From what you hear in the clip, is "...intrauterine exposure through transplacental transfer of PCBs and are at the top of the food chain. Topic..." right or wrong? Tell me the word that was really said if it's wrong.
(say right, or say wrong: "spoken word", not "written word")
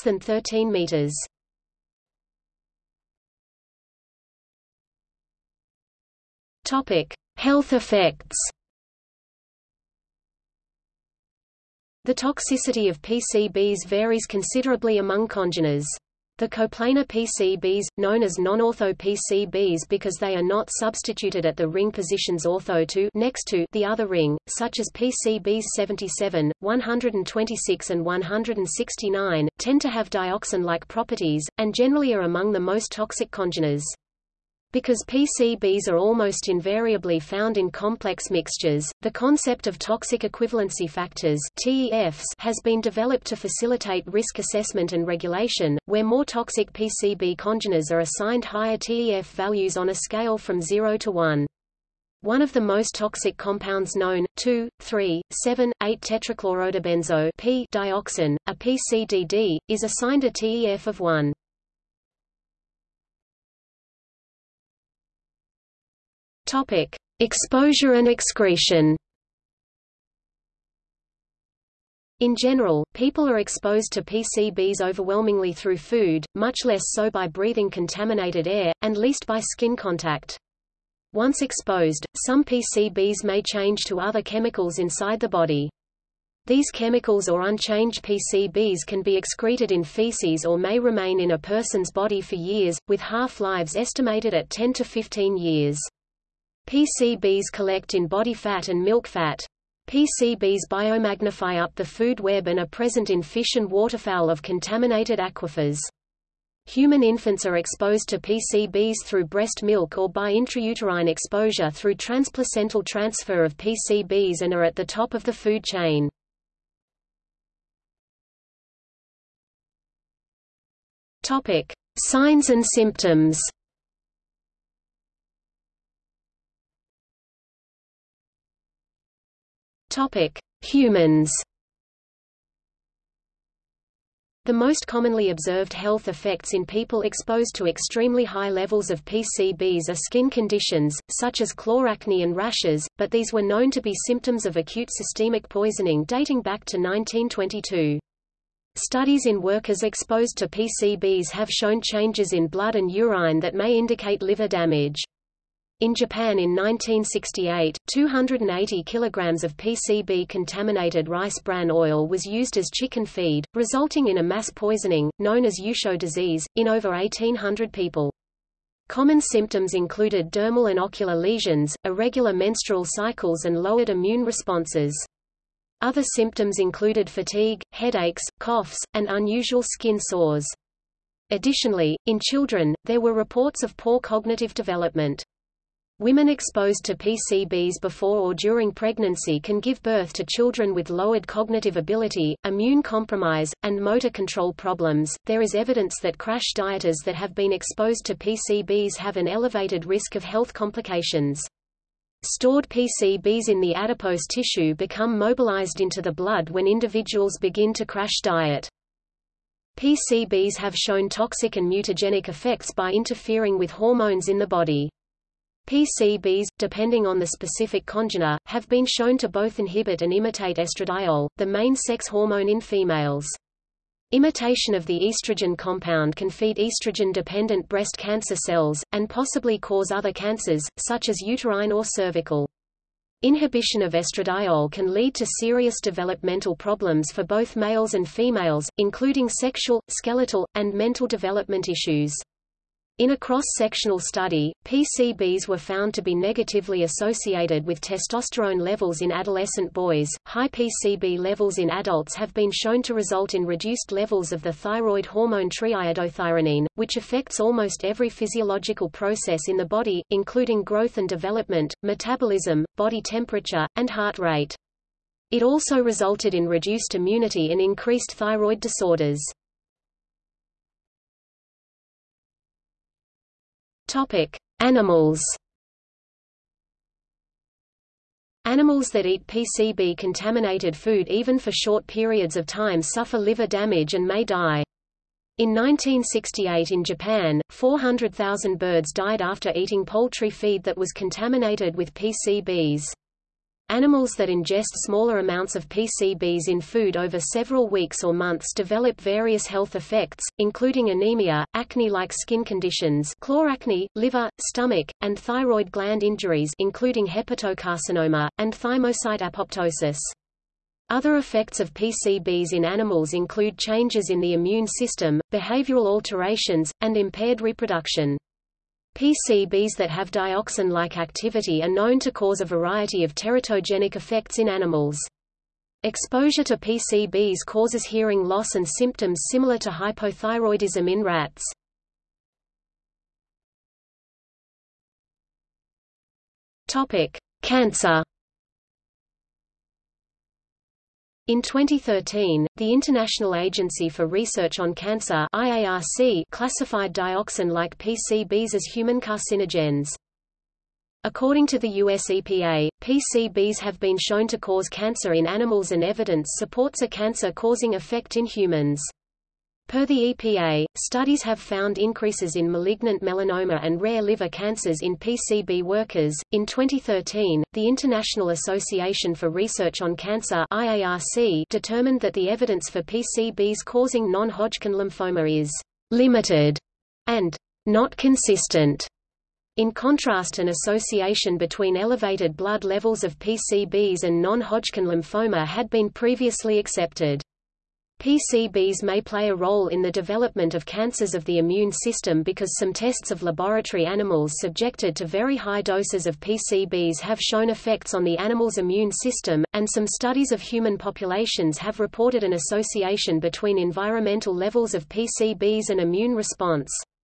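right.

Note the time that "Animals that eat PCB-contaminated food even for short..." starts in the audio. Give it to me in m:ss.
4:38.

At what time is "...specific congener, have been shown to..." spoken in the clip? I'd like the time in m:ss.
3:37.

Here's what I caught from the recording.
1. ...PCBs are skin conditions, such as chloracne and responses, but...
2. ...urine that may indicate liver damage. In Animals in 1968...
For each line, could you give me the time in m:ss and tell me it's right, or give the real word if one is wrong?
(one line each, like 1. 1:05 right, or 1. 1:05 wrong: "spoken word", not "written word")
1. 2:19 wrong: "rashes", not "responses"
2. 2:32 wrong: "Japan", not "Animals".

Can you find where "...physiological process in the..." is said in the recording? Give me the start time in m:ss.
4:18.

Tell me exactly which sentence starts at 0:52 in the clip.
One of the most toxic compounds known, 2, 3, 7, 8 tetrachlorodibenzo P dioxin, a PCDD, is assigned a TEF of 1.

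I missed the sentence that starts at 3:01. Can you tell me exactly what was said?
Additionally, in children, there were reports of poor cognitive development.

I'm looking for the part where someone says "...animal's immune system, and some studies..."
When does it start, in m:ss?
6:38.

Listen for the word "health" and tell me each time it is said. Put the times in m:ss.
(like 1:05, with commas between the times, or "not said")
0:07, 2:15, 3:20, 4:59.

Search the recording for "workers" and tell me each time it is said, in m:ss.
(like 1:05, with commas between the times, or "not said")
2:29, 6:05.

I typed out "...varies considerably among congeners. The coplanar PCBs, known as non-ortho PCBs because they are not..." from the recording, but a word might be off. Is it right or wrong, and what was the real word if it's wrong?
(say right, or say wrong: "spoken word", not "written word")
right.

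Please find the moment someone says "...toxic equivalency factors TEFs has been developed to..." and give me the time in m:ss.
0:39.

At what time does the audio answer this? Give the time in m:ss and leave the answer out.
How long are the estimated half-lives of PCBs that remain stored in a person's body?
1:34.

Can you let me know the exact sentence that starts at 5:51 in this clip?
According to the US EPA, PCBs have been shown to cause cancer in animals and evidence supports a cancer-causing effect in humans.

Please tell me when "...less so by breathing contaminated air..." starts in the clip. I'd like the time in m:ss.
1:16.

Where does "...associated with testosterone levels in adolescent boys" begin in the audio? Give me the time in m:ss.
4:06.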